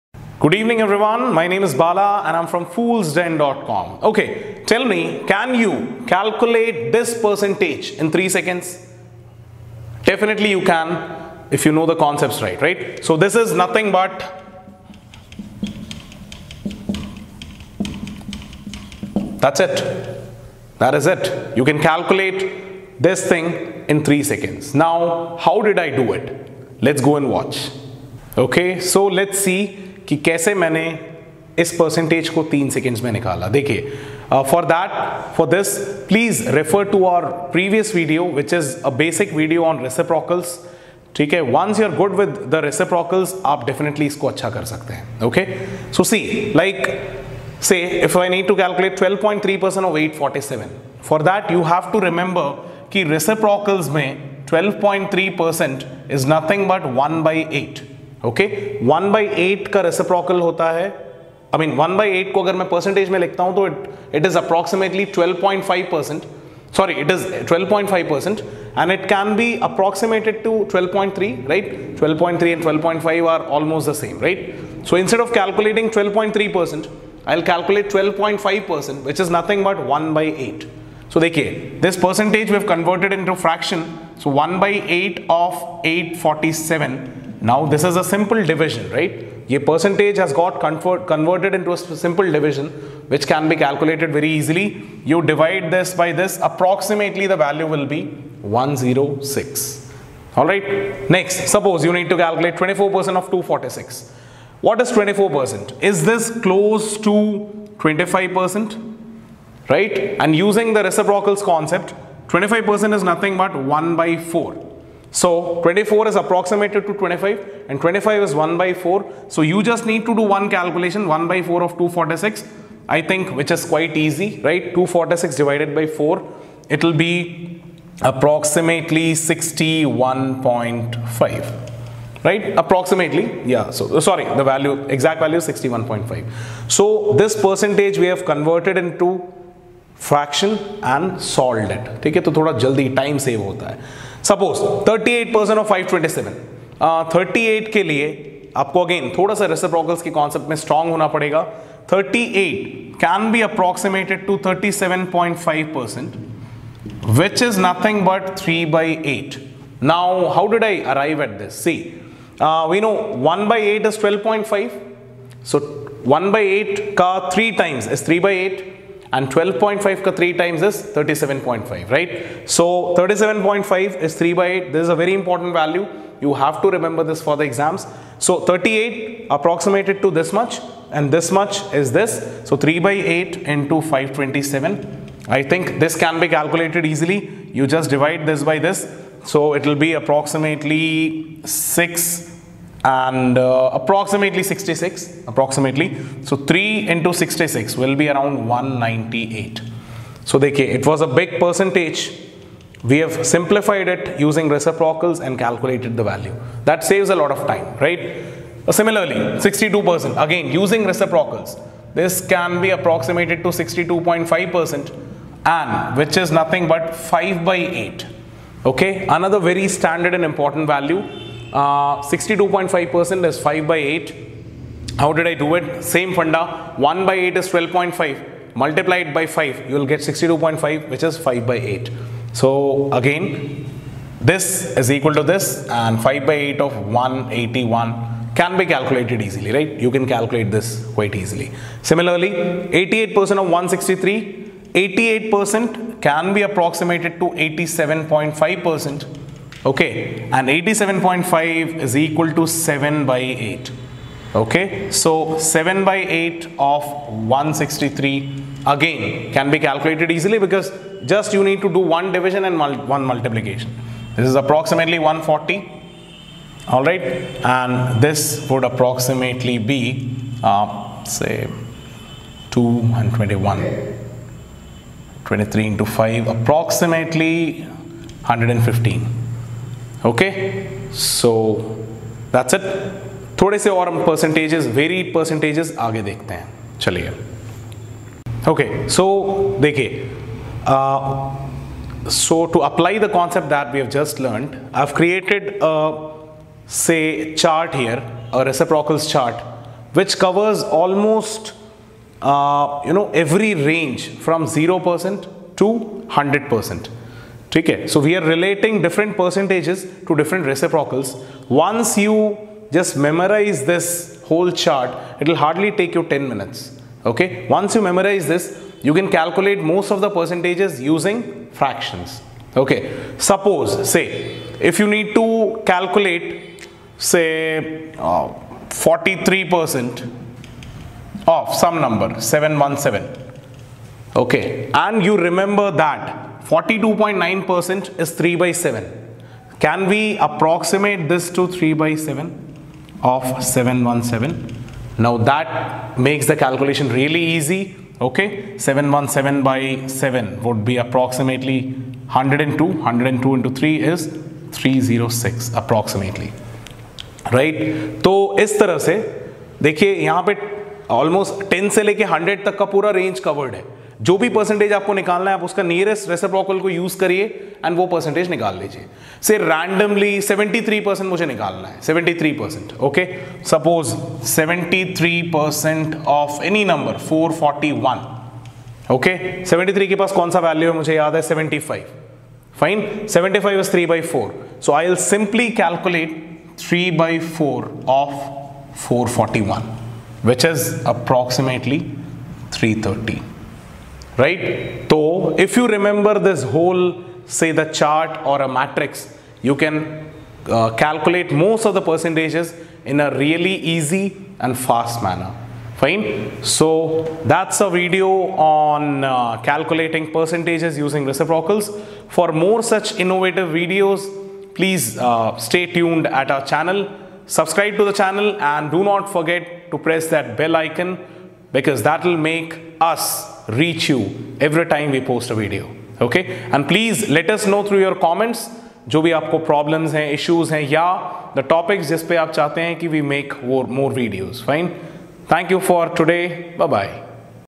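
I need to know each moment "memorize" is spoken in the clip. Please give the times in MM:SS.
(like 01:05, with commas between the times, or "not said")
05:13, 05:17.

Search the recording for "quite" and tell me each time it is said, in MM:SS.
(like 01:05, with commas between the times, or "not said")
02:03, 04:00.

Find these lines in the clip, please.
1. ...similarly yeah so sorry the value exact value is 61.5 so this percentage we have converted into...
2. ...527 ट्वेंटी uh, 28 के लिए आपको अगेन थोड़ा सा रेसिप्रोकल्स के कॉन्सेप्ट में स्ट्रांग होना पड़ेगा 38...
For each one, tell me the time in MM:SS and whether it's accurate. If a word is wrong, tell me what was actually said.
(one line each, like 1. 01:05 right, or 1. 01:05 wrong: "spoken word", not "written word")
1. 02:12 wrong: "approximately", not "similarly"
2. 02:25 wrong: "38", not "28".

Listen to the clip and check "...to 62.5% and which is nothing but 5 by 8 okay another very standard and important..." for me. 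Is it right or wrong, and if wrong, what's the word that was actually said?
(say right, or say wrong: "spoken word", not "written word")
right.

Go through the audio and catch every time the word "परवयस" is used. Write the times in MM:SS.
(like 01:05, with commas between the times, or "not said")
00:37.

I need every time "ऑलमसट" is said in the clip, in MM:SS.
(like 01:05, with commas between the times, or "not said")
01:13, 05:00, 06:00.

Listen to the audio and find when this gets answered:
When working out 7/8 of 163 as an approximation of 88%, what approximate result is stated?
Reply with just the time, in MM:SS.
04:24.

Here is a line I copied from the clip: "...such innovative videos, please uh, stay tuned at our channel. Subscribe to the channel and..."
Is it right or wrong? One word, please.
right.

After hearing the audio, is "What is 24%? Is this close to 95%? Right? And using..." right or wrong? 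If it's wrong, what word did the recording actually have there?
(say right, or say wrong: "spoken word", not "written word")
wrong: "25", not "95".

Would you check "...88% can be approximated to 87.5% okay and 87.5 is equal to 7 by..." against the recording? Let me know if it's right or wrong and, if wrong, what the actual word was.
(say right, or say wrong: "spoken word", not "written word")
right.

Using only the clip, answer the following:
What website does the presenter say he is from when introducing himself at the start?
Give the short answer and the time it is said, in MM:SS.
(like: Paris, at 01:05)
foolsden.com, at 00:02.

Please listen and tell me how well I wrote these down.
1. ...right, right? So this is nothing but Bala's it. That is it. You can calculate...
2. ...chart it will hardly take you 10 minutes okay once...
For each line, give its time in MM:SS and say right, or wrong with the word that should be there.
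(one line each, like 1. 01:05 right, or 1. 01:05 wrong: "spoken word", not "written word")
1. 00:12 wrong: "That", not "Bala"
2. 05:14 right.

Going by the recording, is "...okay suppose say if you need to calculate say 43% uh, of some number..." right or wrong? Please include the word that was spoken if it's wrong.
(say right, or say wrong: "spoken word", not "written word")
right.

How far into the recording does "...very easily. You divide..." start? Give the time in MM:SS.
01:34.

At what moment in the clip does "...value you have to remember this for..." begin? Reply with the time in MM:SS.
02:55.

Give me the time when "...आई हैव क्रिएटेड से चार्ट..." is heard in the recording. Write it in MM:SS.
04:54.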